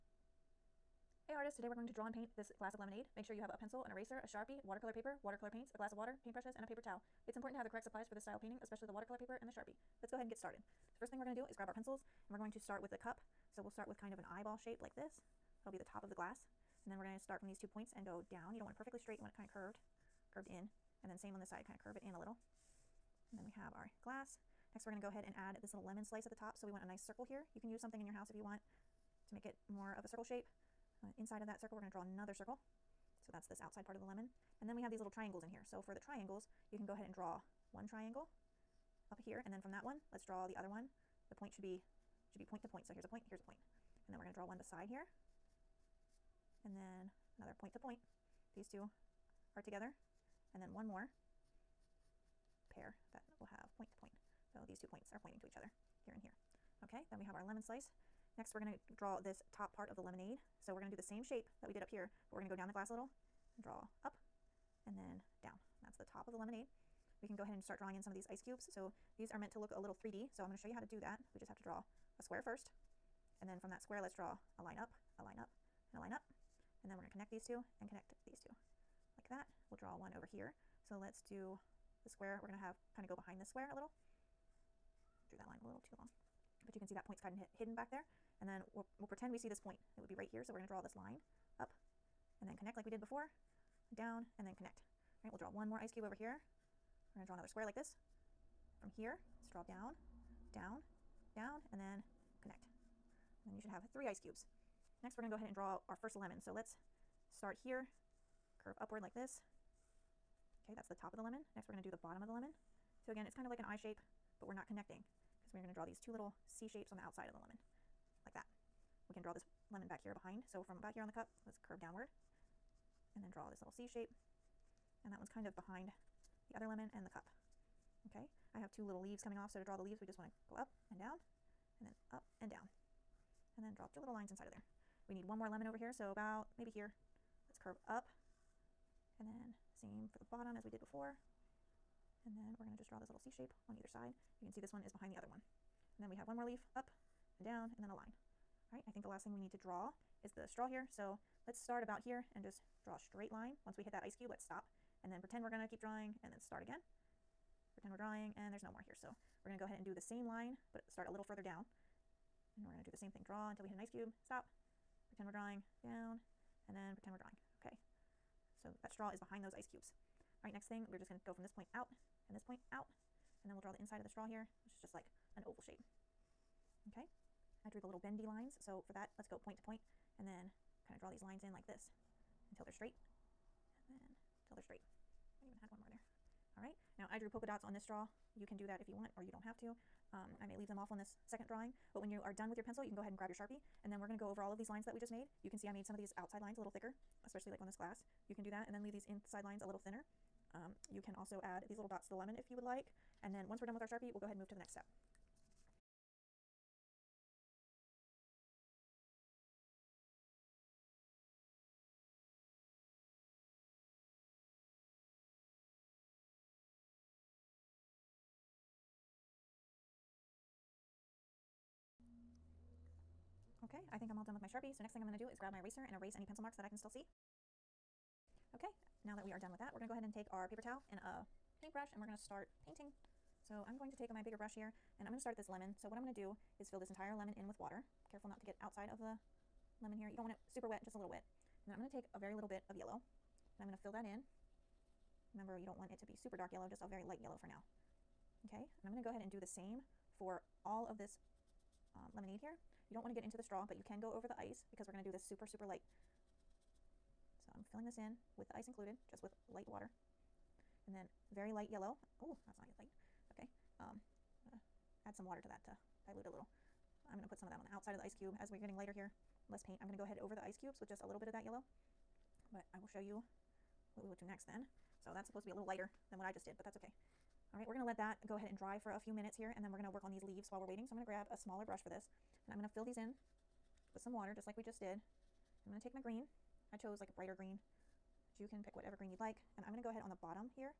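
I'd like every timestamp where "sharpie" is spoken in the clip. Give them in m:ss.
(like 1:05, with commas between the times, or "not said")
0:04, 0:09, 3:13, 3:23, 3:44.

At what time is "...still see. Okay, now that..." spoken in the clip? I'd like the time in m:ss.
3:46.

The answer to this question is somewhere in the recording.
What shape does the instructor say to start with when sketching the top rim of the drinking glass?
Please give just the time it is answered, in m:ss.
0:14.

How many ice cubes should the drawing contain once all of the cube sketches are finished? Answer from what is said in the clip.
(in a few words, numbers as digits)
3.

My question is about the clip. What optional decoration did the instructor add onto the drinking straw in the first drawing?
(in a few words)
polka dots.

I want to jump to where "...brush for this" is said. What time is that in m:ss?
4:41.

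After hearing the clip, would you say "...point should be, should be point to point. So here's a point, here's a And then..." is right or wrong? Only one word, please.
right.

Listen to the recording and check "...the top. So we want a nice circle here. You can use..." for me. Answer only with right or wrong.
right.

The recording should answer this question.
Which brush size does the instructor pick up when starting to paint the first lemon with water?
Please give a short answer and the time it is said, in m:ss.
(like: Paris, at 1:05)
bigger brush, at 3:54.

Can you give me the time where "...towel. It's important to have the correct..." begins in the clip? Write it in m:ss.
0:06.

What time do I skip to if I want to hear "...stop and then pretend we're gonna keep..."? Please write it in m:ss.
2:34.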